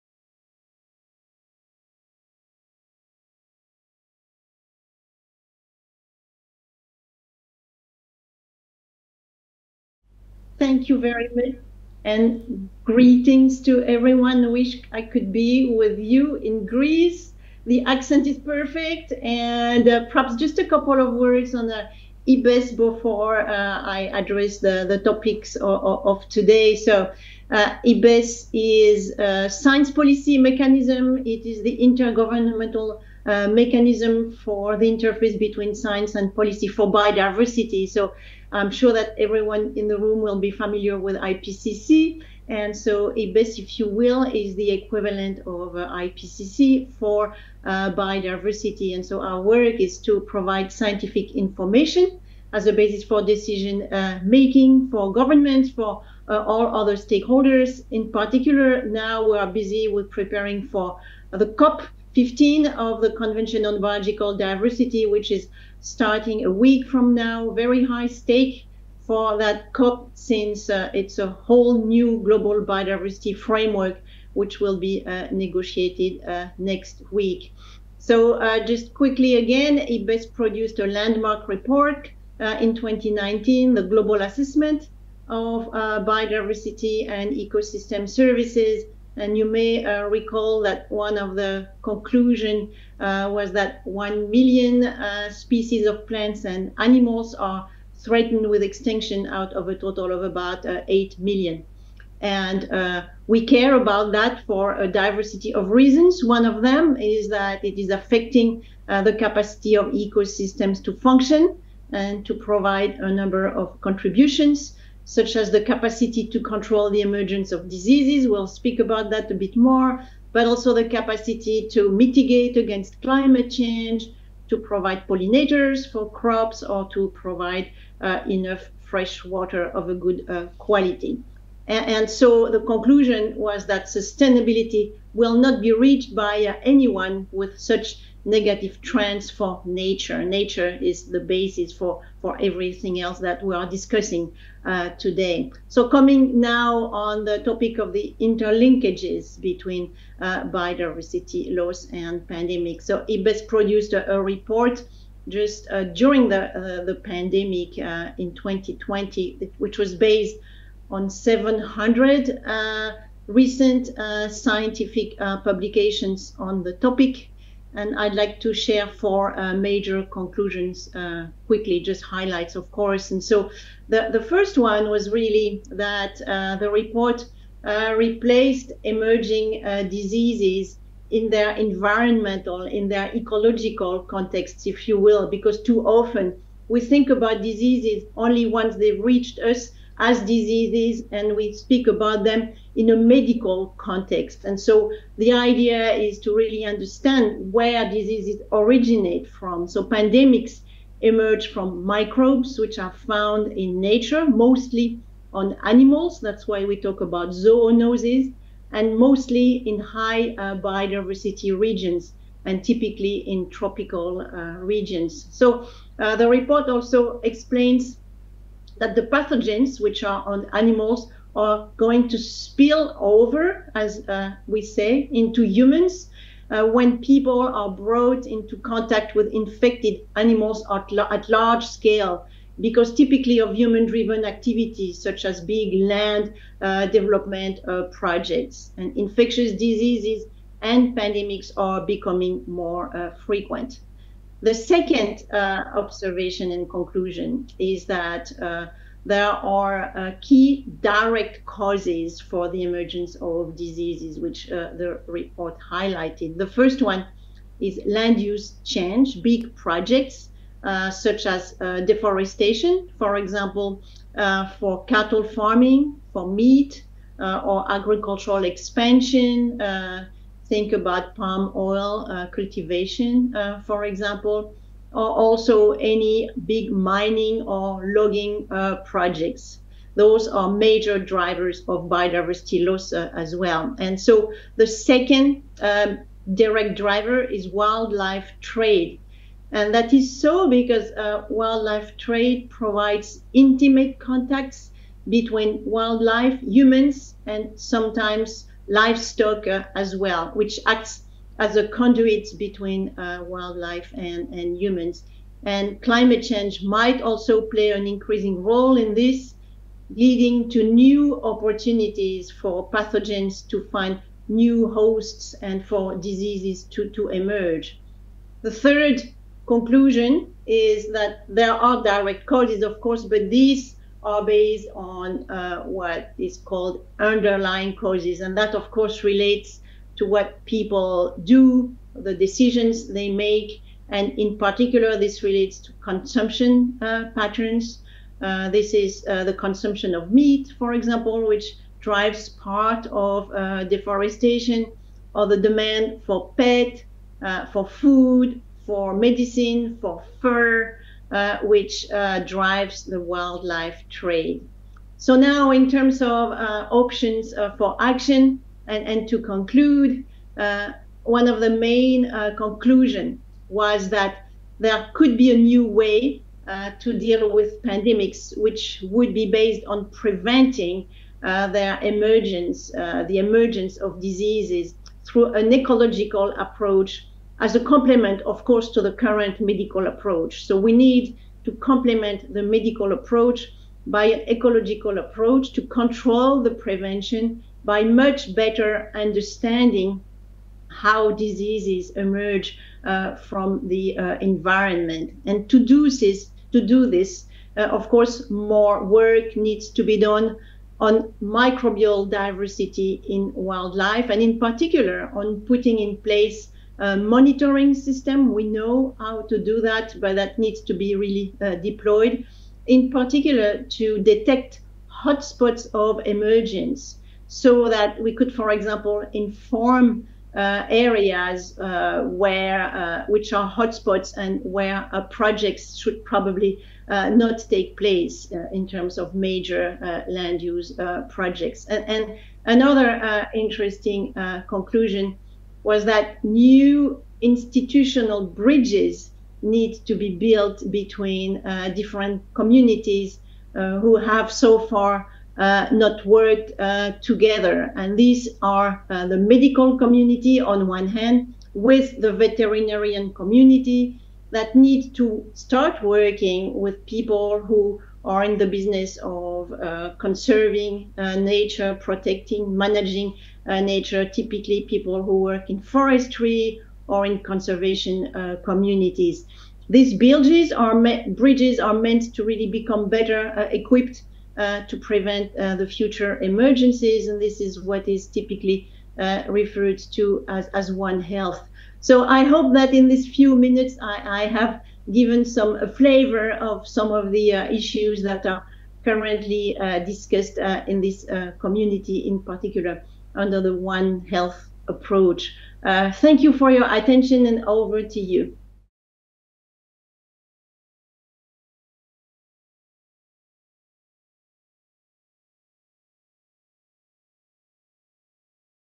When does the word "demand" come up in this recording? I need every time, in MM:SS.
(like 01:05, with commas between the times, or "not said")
05:45.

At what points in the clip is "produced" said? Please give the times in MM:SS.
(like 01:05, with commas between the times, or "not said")
01:20, 02:33.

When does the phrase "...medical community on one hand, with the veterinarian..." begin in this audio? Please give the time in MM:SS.
07:29.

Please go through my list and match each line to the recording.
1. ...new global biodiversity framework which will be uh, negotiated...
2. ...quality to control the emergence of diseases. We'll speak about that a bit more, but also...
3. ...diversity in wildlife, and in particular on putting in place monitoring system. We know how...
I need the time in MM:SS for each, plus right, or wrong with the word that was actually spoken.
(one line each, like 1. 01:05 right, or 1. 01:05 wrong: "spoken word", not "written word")
1. 01:11 right
2. 01:55 wrong: "capacity", not "quality"
3. 06:42 right.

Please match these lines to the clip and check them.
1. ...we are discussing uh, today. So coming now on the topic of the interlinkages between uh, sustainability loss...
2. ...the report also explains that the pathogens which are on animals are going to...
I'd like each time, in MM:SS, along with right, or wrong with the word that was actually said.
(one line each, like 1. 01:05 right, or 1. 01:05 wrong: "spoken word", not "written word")
1. 02:23 wrong: "biodiversity", not "sustainability"
2. 03:36 right.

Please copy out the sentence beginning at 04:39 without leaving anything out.
Those are major drivers of biodiversity loss uh, as well.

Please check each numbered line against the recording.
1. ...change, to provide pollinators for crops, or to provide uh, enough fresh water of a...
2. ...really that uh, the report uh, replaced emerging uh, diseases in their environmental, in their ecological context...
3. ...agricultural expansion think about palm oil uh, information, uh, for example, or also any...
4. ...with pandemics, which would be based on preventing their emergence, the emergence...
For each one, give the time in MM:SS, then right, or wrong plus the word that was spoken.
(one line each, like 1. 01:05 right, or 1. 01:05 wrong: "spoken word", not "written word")
1. 02:03 right
2. 02:55 right
3. 04:27 wrong: "cultivation", not "information"
4. 06:07 right.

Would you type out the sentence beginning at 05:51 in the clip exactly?
Uh, which uh, drives the wildlife trade.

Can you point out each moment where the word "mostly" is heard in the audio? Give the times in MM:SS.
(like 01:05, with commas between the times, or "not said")
03:24, 03:28.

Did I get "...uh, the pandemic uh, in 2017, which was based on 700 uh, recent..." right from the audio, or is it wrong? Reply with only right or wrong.
wrong.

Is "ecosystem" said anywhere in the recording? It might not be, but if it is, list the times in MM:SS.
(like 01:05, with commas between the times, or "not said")
01:27, 01:49.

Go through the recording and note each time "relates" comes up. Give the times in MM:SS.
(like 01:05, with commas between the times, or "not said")
05:29, 05:35.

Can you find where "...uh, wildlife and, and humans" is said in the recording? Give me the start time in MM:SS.
05:02.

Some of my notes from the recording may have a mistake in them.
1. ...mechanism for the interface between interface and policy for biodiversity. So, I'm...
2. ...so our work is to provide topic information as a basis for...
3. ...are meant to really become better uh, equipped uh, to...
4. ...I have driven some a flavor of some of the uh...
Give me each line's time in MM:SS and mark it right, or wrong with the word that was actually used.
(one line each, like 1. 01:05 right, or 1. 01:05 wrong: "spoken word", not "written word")
1. 00:33 wrong: "science", not "interface"
2. 00:49 wrong: "scientific", not "topic"
3. 07:51 right
4. 08:04 wrong: "given", not "driven".